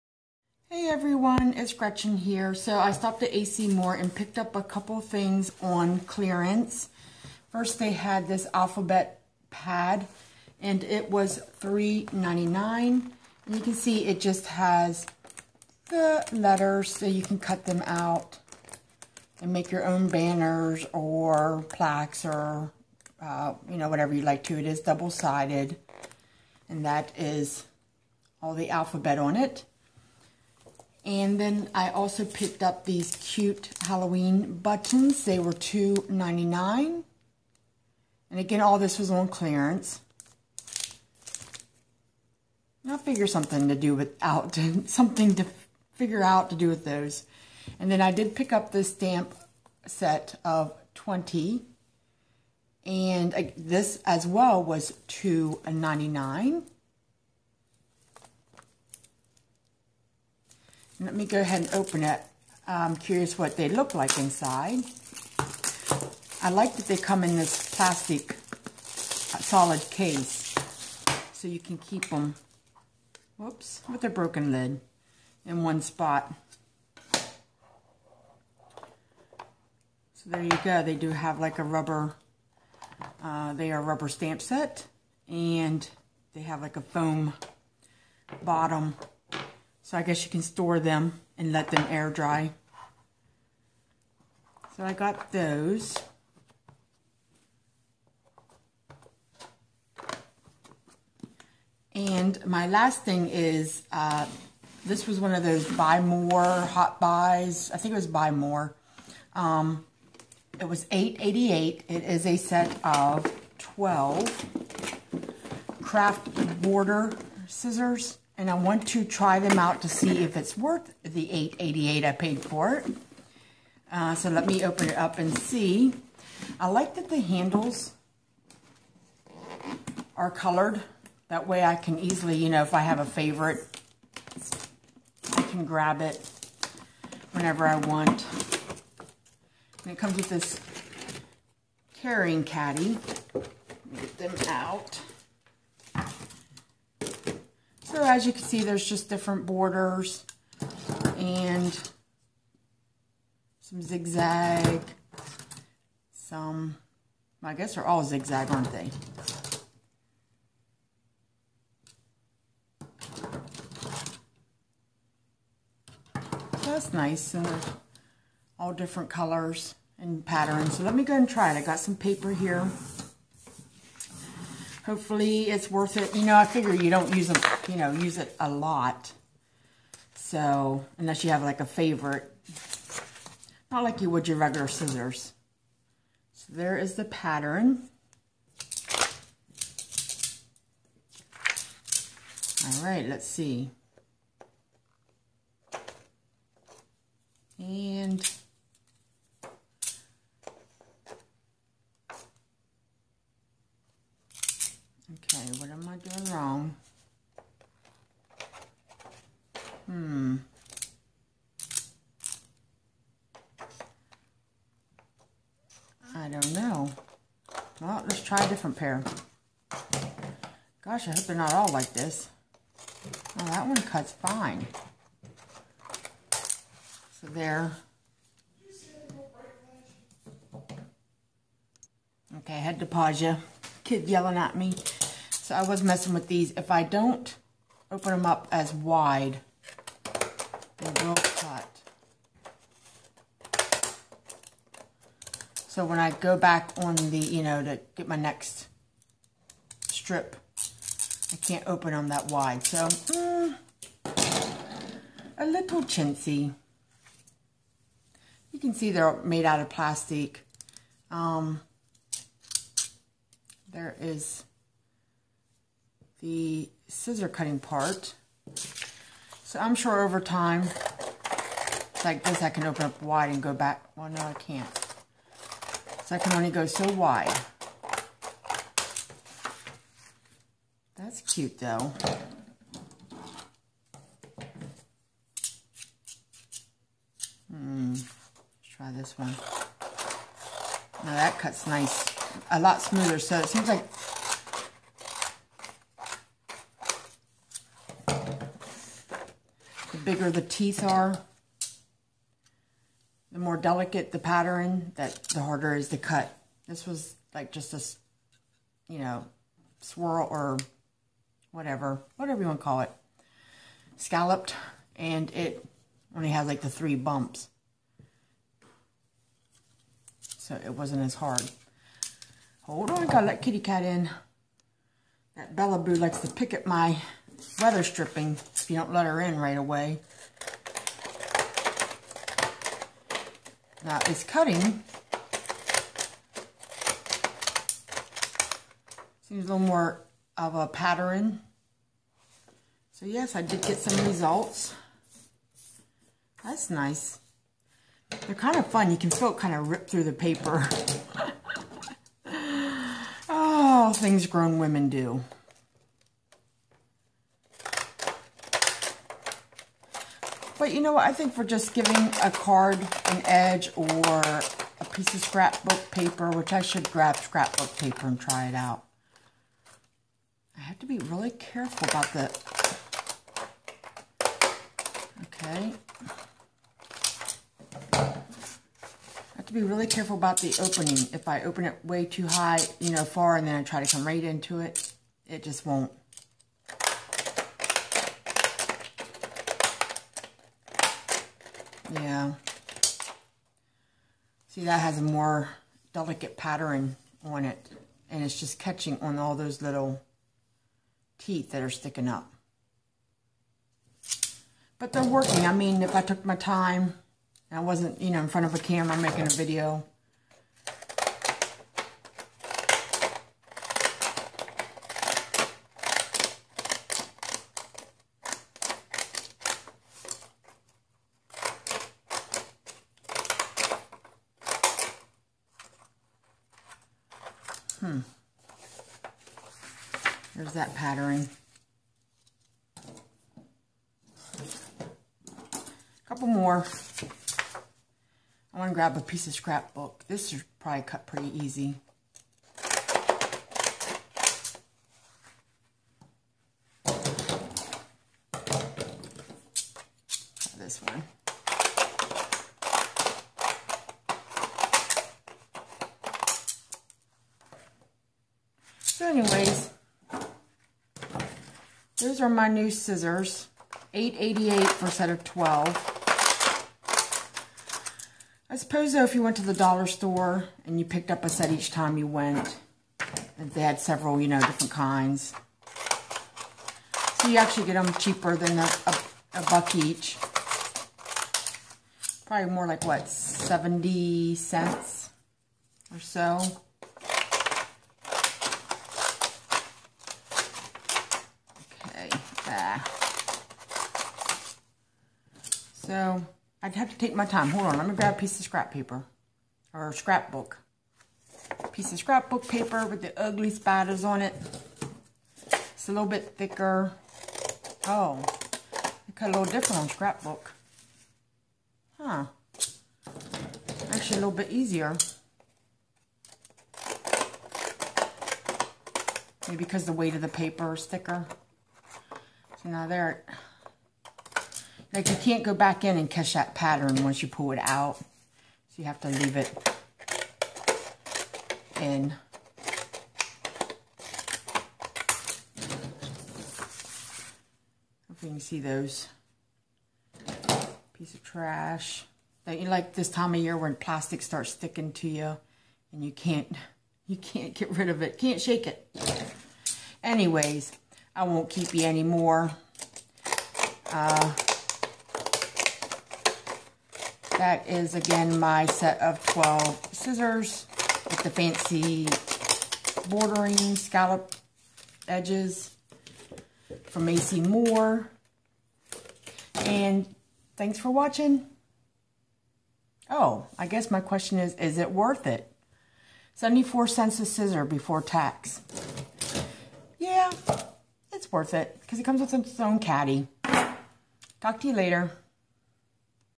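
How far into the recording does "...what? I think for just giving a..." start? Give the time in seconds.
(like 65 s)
360 s.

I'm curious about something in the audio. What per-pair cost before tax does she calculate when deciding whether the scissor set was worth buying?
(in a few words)
74 cents.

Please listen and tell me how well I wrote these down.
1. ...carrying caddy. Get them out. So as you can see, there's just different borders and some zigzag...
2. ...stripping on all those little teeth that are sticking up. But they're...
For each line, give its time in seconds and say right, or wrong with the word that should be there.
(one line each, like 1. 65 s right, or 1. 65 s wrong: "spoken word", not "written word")
1. 141 s right
2. 398 s wrong: "catching", not "stripping".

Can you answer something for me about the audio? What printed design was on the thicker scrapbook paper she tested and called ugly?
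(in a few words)
spiders.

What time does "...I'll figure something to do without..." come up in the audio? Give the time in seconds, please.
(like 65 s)
42 s.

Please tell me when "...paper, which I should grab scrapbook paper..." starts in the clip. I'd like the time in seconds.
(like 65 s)
365 s.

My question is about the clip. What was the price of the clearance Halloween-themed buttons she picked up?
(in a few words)
$2.99.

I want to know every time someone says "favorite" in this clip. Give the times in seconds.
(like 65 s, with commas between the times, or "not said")
133 s, 181 s.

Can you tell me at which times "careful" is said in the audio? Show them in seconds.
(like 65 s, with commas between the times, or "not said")
371 s, 379 s.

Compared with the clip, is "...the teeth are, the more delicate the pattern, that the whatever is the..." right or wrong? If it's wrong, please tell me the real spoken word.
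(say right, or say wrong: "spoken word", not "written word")
wrong: "harder", not "whatever".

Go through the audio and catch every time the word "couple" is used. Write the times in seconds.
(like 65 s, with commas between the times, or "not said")
4 s, 436 s.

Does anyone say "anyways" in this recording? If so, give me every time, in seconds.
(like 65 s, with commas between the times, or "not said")
459 s, 550 s.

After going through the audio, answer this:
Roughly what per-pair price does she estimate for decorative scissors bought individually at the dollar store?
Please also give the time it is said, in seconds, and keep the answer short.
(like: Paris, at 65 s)
70 cents, at 483 s.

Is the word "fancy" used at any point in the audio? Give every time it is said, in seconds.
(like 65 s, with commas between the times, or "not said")
561 s.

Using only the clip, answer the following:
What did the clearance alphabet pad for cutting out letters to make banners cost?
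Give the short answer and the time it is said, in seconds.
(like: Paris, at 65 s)
$3.99, at 11 s.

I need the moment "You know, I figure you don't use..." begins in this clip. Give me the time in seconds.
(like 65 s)
176 s.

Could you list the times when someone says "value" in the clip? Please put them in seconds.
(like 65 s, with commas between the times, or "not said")
not said.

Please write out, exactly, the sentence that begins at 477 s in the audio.
So you actually get them cheaper than a, a, a buck each.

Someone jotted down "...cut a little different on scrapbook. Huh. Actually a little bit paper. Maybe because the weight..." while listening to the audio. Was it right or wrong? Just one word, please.
wrong.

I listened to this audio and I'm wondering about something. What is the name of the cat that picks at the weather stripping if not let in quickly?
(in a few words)
Bella Boo.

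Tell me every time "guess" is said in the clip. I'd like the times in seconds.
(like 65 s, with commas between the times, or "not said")
90 s, 157 s, 573 s.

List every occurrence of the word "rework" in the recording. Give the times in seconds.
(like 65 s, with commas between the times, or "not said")
not said.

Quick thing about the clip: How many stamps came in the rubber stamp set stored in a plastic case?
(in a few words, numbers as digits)
20.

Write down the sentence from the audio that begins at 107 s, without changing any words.
I think it was buy more.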